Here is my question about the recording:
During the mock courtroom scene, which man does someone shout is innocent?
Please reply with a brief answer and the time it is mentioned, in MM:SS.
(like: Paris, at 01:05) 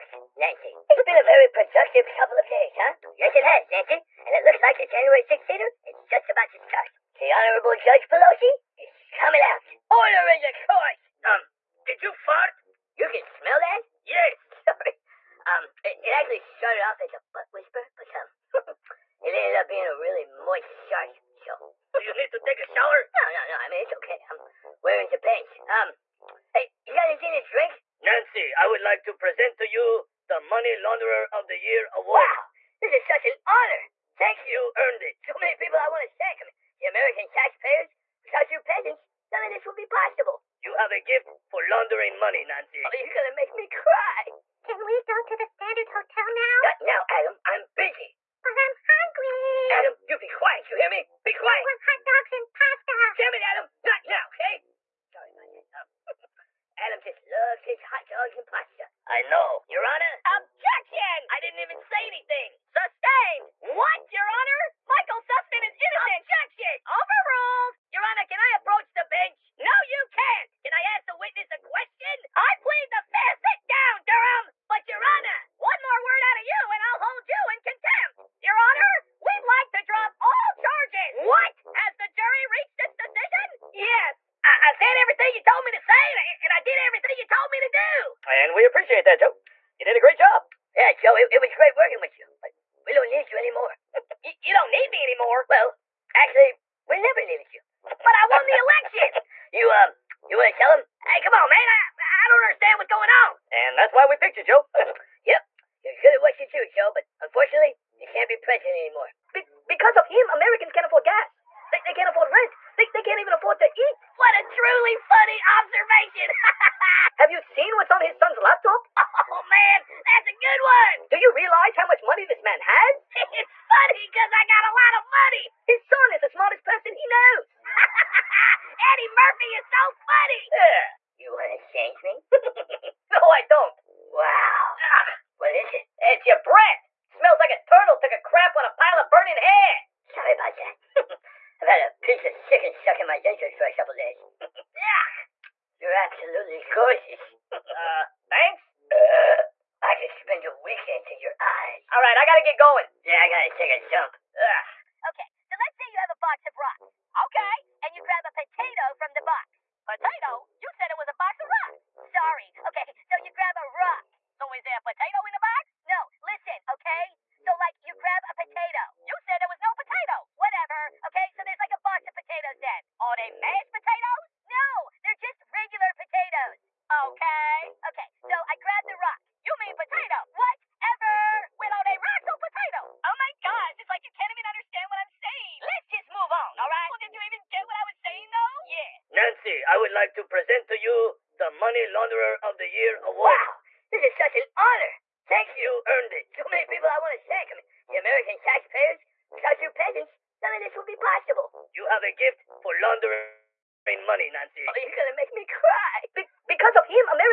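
Michael Sussmann, at 01:04.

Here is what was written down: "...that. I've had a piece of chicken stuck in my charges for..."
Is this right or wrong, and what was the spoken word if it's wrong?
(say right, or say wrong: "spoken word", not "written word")
wrong: "dentures", not "charges".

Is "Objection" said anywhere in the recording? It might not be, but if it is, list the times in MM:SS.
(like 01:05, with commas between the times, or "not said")
01:00, 01:06.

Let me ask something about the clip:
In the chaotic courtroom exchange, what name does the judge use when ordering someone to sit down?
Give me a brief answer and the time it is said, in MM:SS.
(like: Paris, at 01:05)
Durham, at 01:14.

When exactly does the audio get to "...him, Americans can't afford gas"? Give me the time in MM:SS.
01:50.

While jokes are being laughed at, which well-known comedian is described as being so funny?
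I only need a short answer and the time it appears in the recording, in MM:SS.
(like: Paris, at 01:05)
Eddie Murphy, at 02:08.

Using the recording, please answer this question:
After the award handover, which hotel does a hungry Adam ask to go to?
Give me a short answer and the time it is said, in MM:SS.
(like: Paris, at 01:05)
Standard Hotel, at 00:45.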